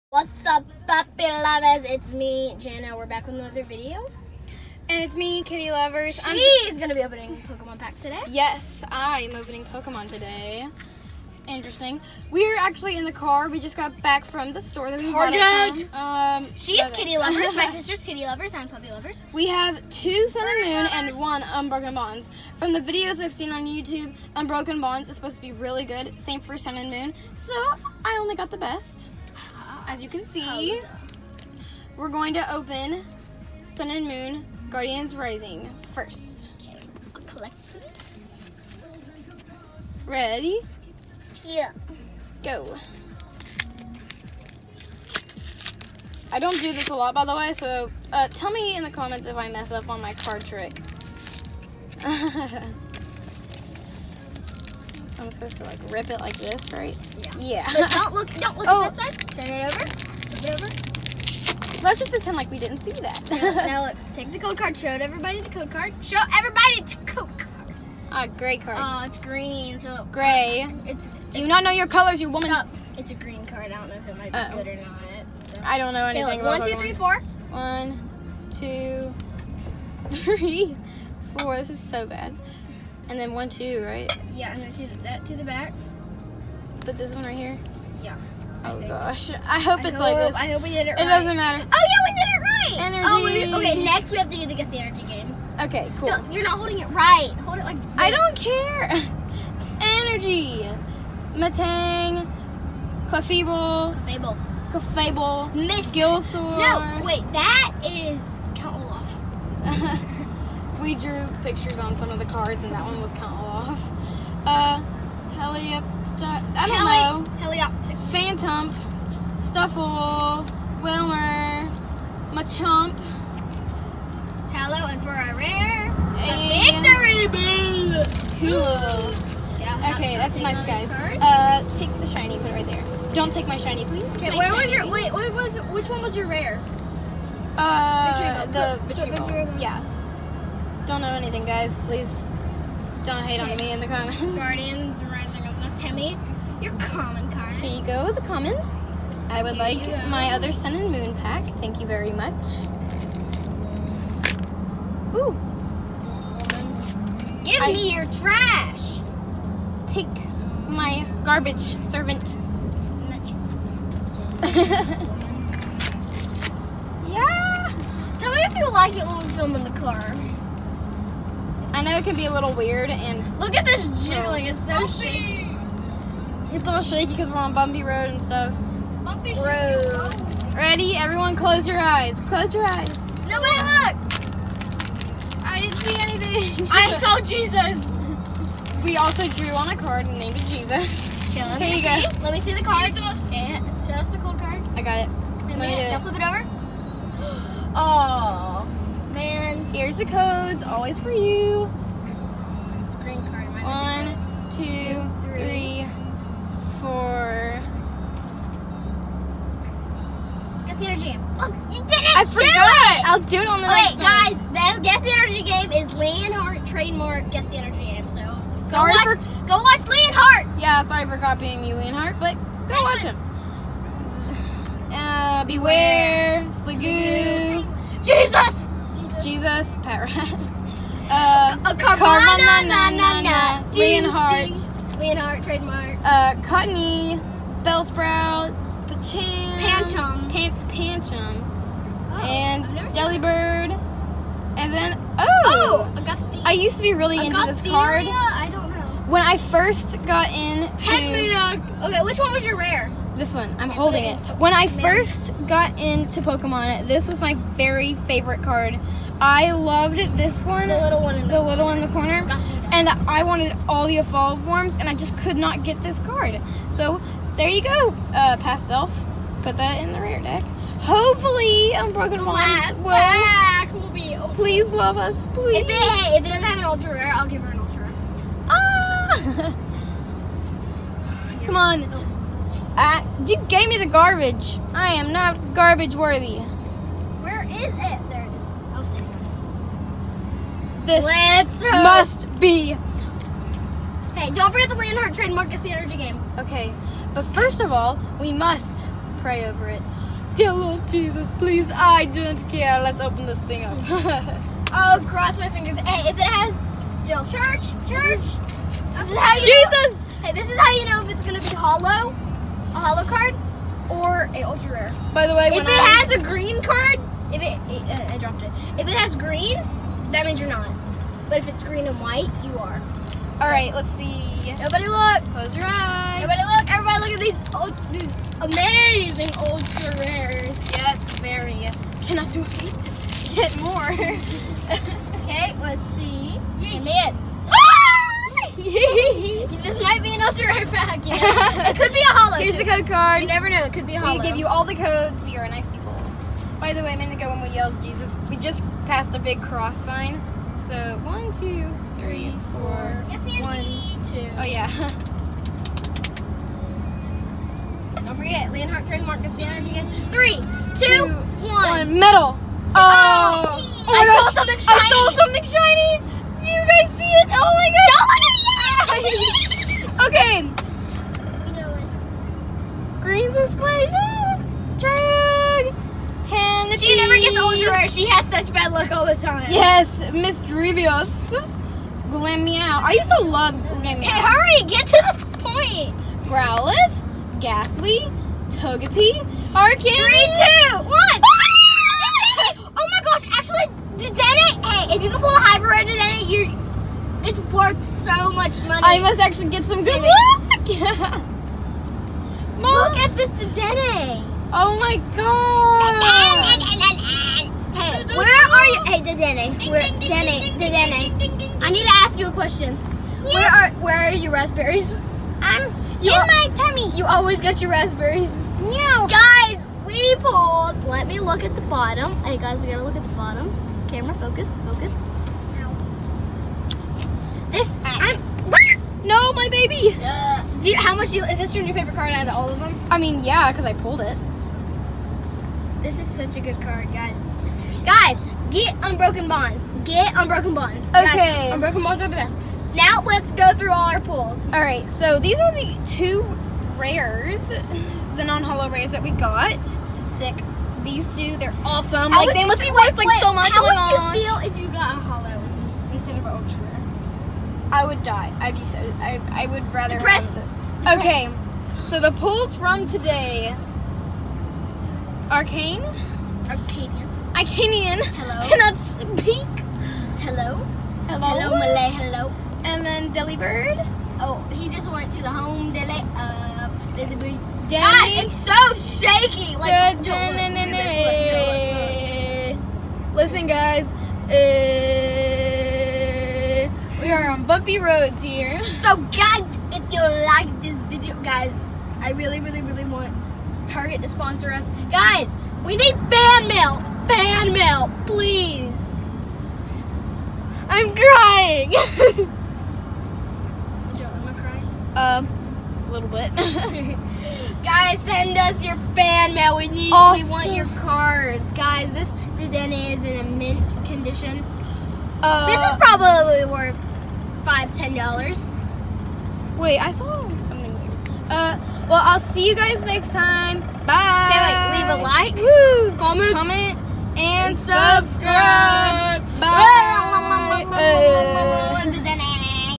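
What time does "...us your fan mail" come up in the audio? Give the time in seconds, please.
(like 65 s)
508 s.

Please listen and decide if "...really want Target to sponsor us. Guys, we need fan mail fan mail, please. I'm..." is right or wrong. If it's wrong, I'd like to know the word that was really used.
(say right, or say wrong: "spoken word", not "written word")
right.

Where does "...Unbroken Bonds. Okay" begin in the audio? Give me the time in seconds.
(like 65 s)
440 s.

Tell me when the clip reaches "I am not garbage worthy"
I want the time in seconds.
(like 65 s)
284 s.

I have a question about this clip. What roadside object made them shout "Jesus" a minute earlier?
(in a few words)
big cross sign.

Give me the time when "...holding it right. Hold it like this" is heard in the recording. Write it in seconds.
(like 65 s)
96 s.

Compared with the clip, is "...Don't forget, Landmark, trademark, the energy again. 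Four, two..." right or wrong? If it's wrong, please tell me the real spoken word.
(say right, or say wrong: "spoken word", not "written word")
wrong: "Three", not "Four".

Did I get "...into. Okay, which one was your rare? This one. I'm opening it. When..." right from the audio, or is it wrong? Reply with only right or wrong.
wrong.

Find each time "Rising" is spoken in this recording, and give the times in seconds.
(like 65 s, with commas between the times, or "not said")
35 s, 145 s.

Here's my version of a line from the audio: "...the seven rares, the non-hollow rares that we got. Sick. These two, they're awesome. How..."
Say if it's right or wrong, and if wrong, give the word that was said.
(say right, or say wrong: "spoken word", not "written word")
wrong: "two", not "seven".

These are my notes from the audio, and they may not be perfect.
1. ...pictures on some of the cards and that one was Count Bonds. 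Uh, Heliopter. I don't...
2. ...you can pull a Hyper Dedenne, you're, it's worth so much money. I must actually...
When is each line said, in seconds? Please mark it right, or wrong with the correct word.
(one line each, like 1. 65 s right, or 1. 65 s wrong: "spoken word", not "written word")
1. 111 s wrong: "Olaf", not "Bonds"
2. 395 s right.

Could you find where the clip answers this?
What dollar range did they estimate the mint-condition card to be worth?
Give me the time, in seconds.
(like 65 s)
517 s.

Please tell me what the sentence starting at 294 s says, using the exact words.
Hey, don't forget the Landhart trademark.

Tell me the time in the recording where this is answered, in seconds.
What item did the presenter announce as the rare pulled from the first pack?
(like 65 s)
126 s.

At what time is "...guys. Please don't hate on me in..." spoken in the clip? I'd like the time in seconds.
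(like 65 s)
141 s.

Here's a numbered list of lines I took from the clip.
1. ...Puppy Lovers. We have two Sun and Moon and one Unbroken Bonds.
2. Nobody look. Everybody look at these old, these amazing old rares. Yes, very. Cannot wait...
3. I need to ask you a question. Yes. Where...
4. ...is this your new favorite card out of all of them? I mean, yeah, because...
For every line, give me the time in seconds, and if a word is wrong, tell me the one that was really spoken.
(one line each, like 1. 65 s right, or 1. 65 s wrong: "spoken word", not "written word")
1. 18 s right
2. 326 s right
3. 411 s right
4. 431 s right.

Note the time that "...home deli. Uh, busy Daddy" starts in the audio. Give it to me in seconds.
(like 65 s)
475 s.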